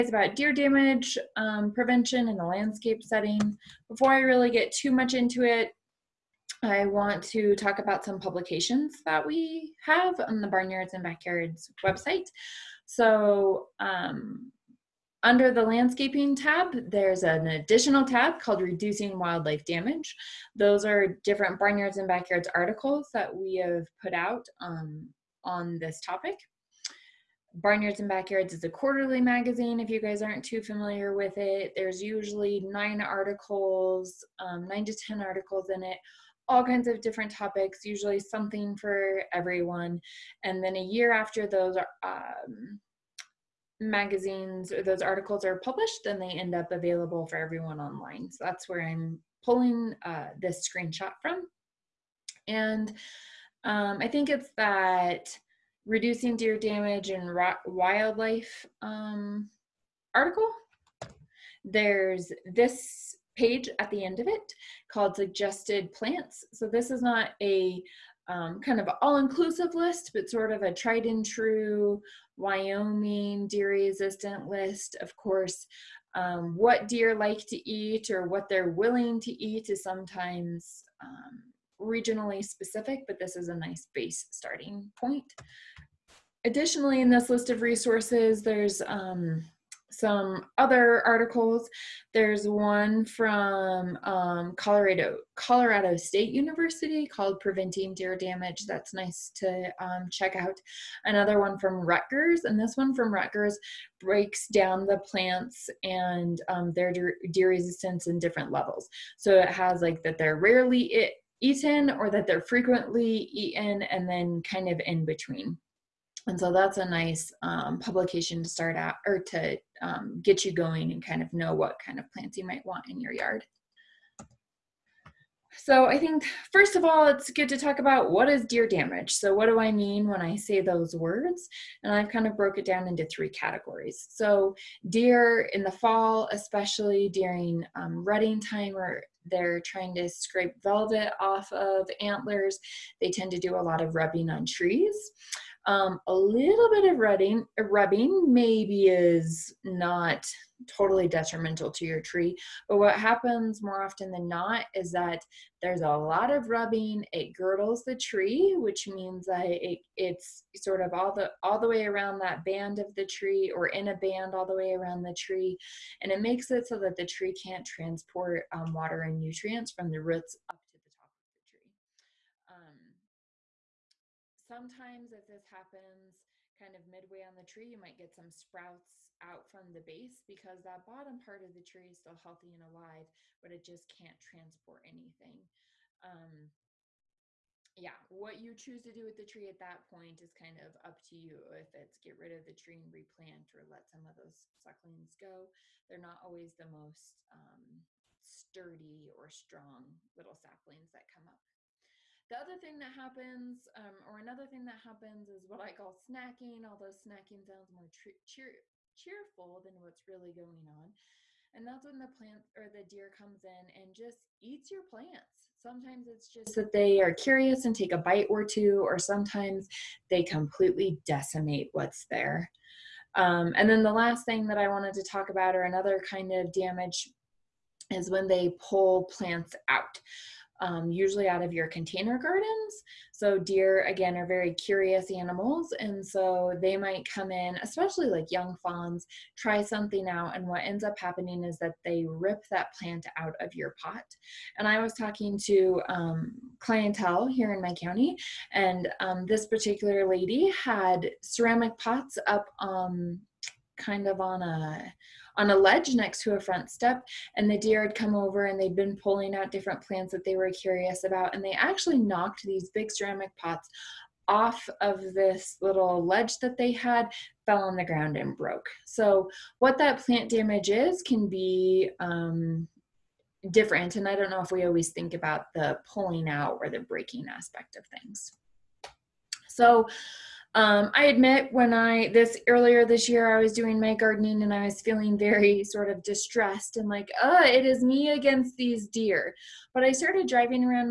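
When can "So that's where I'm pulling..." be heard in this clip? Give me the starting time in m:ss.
0:48.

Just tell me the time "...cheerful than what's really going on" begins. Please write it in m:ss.
3:28.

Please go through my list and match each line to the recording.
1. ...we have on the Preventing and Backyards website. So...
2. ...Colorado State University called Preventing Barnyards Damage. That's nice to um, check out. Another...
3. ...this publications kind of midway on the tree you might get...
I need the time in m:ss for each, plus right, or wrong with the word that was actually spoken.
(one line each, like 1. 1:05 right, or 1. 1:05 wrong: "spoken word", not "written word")
1. 0:09 wrong: "Barnyards", not "Preventing"
2. 1:35 wrong: "Deer", not "Barnyards"
3. 2:55 wrong: "happens", not "publications".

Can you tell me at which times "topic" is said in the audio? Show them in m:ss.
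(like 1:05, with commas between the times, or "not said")
0:26, 0:37.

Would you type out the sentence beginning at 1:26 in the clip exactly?
Additionally, in this list of resources, there's um, some other articles.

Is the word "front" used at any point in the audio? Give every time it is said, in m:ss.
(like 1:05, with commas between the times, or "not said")
4:16.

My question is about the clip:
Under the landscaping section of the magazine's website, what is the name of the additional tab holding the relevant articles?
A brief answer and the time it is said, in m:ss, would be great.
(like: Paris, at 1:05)
Reducing Wildlife Damage, at 0:18.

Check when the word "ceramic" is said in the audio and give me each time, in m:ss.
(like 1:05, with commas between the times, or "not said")
4:11, 4:22.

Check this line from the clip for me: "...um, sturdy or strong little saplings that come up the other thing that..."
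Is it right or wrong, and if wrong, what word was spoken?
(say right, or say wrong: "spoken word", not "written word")
right.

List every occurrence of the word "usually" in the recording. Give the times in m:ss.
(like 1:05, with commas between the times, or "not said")
0:32, 0:37, 3:50.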